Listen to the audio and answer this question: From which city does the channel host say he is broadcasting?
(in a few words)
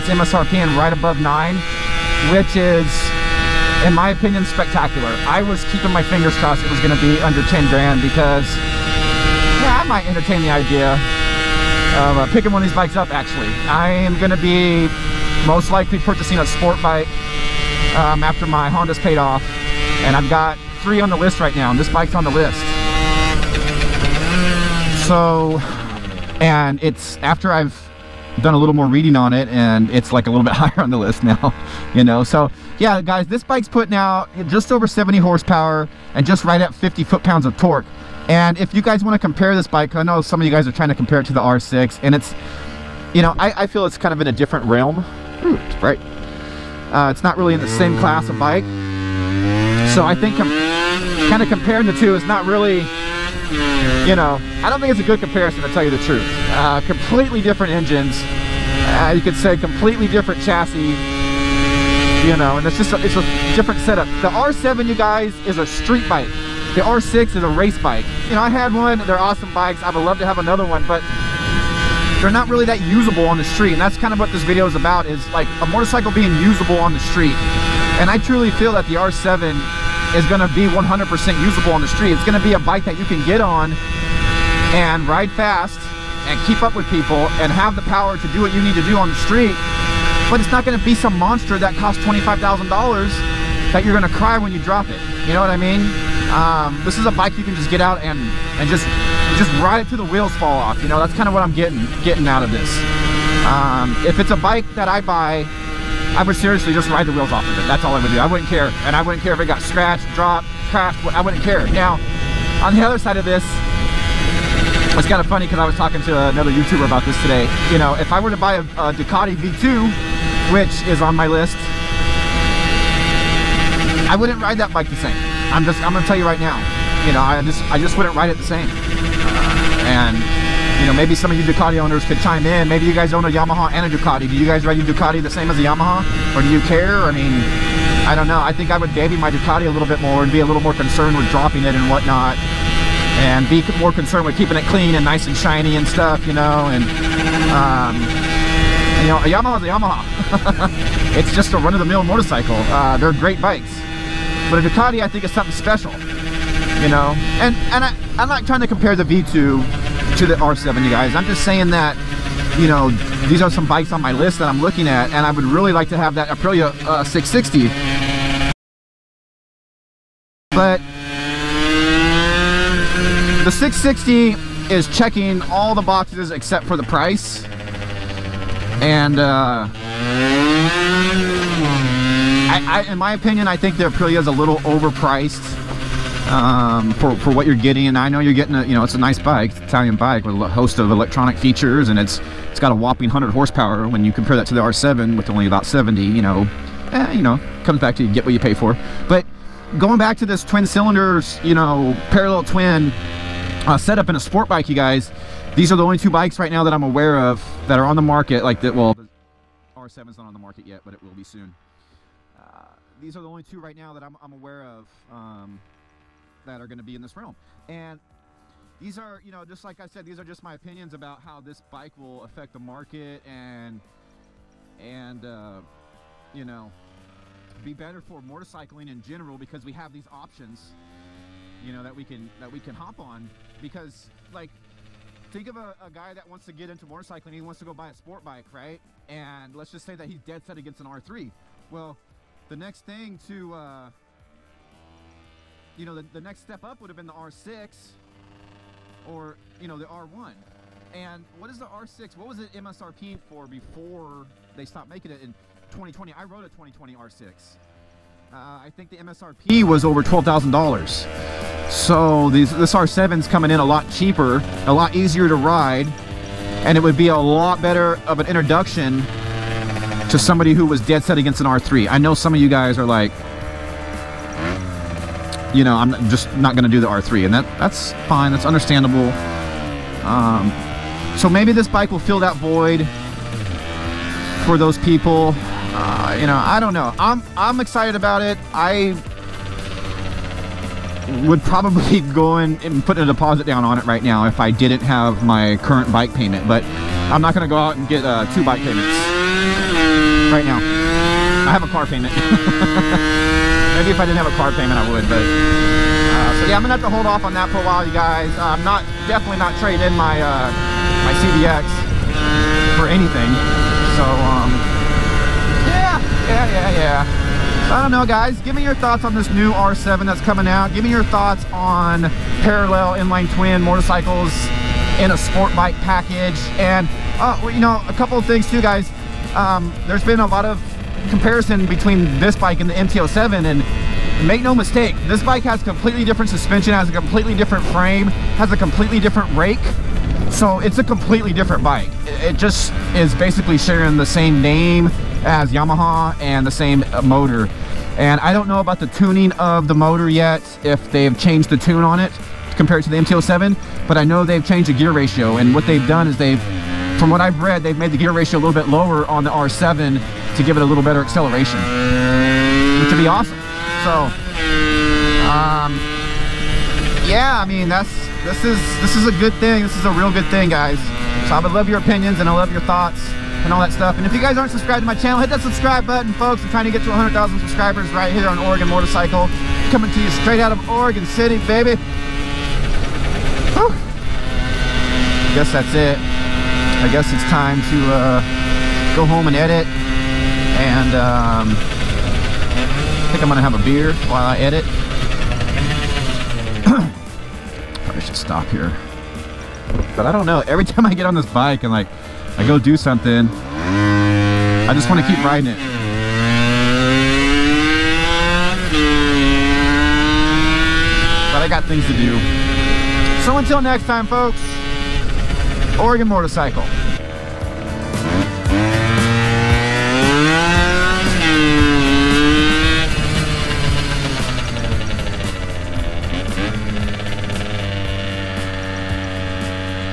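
Oregon City.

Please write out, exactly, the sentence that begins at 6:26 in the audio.
I guess it's time to uh, go home and edit and um, I think I'm gonna have a beer while I edit.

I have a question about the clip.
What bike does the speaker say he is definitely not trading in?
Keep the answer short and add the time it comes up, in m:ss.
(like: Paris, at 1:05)
CVX, at 5:11.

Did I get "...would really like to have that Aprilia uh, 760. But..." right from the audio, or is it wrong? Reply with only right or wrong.
wrong.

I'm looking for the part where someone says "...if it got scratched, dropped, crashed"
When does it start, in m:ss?
1:49.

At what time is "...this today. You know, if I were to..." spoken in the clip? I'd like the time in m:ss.
1:57.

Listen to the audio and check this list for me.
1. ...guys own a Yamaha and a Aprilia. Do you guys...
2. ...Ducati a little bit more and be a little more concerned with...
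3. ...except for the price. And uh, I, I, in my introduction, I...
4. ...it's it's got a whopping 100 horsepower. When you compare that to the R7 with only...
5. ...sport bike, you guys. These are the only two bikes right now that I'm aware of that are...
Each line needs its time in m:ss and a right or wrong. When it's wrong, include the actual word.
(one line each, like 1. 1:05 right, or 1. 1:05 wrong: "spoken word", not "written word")
1. 2:12 wrong: "Ducati", not "Aprilia"
2. 2:19 right
3. 2:56 wrong: "opinion", not "introduction"
4. 3:11 right
5. 3:24 right.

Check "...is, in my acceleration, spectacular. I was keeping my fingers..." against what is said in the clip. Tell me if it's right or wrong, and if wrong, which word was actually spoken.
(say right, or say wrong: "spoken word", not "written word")
wrong: "opinion", not "acceleration".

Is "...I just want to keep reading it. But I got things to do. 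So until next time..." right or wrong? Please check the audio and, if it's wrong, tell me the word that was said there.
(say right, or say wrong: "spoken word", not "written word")
wrong: "riding", not "reading".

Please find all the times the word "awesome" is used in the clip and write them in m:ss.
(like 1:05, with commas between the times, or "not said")
1:09, 6:03.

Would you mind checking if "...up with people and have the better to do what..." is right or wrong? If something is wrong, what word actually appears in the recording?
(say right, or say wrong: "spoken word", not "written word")
wrong: "power", not "better".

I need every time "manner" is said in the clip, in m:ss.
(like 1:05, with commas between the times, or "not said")
not said.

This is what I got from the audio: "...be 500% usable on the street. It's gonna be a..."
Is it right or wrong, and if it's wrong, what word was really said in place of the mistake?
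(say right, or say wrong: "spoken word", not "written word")
wrong: "100", not "500".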